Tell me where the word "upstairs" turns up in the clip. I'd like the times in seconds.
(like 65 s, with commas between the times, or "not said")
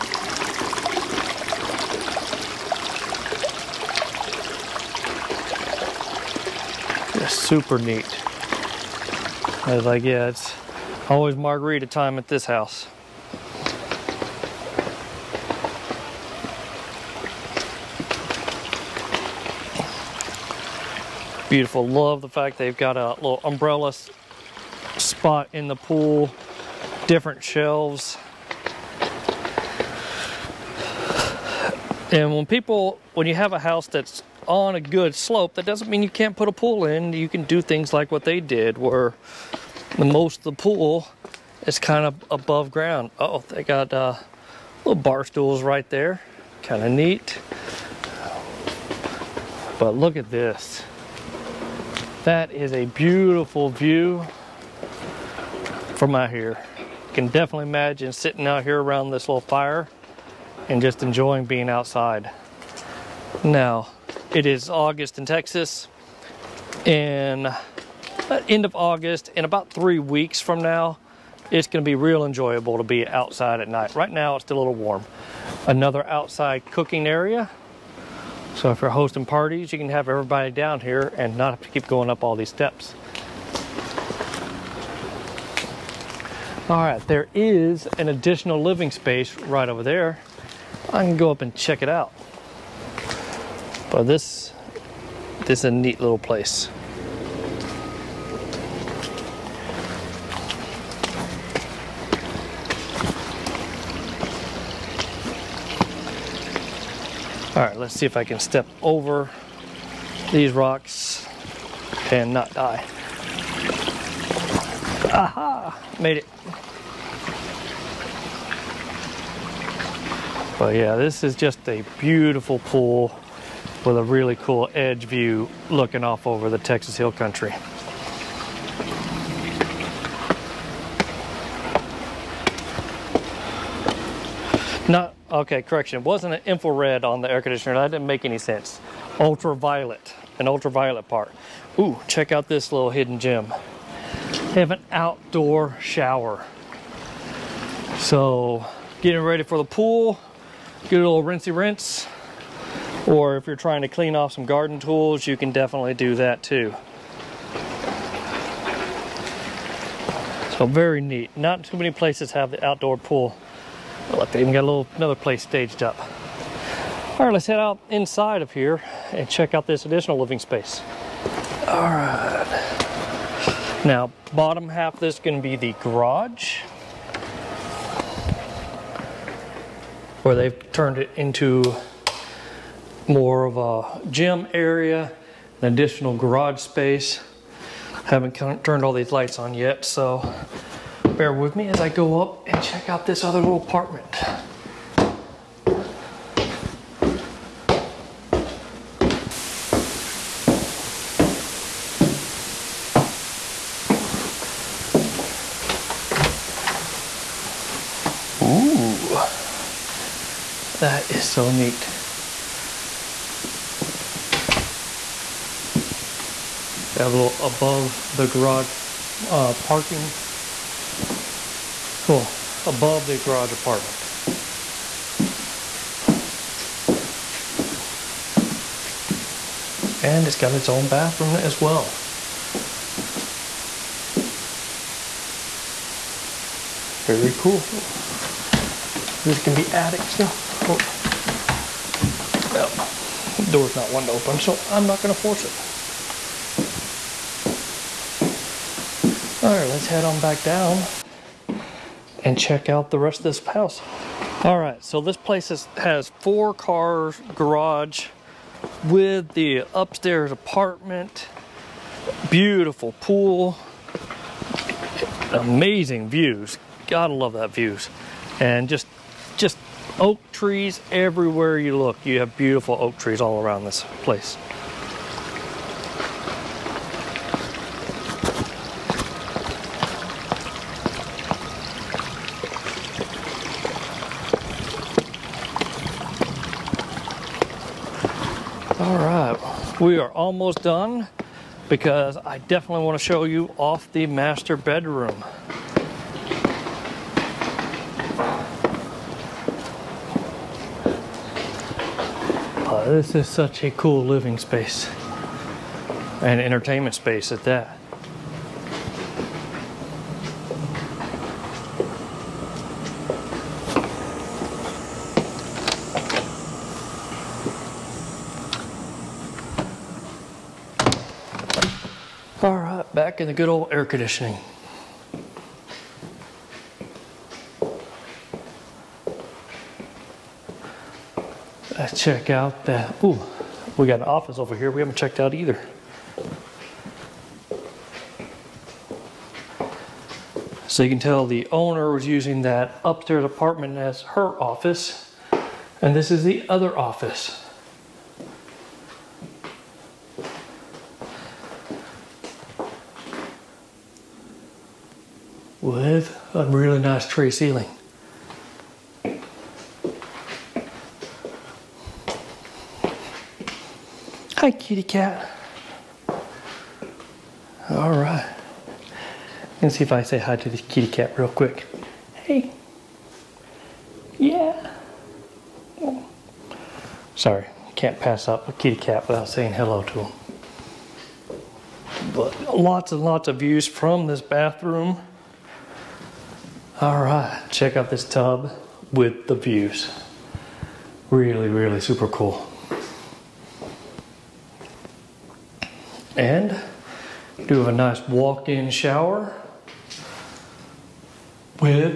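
259 s, 342 s.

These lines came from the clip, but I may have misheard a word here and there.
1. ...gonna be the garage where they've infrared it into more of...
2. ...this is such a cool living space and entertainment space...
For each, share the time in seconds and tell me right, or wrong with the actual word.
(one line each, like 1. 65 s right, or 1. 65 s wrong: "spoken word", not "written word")
1. 175 s wrong: "turned", not "infrared"
2. 302 s right.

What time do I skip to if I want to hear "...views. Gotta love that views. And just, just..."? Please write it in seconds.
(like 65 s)
266 s.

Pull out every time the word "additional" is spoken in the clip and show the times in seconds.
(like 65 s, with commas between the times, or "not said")
88 s, 169 s, 185 s.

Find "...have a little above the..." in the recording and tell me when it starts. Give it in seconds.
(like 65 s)
217 s.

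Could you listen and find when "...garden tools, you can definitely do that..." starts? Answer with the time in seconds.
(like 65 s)
154 s.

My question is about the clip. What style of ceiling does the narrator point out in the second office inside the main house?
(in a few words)
Tray ceiling.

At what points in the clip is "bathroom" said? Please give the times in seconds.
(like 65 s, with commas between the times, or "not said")
230 s, 384 s.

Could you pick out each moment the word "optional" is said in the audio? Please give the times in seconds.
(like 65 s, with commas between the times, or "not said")
not said.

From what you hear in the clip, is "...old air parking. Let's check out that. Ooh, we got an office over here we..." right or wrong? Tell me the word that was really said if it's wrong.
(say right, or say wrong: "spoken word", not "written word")
wrong: "conditioning", not "parking".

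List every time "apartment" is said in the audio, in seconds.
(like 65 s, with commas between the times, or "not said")
193 s, 223 s, 260 s, 343 s.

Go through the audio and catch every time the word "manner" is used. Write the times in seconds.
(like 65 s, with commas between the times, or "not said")
not said.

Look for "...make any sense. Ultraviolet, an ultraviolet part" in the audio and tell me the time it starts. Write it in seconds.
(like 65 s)
138 s.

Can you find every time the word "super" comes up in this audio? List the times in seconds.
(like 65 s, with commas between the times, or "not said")
7 s, 391 s.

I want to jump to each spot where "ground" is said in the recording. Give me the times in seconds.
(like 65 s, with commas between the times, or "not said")
42 s.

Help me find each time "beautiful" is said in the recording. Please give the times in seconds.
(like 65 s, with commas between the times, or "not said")
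21 s, 52 s, 121 s, 262 s, 272 s.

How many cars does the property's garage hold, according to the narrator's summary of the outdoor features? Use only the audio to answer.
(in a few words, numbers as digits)
4.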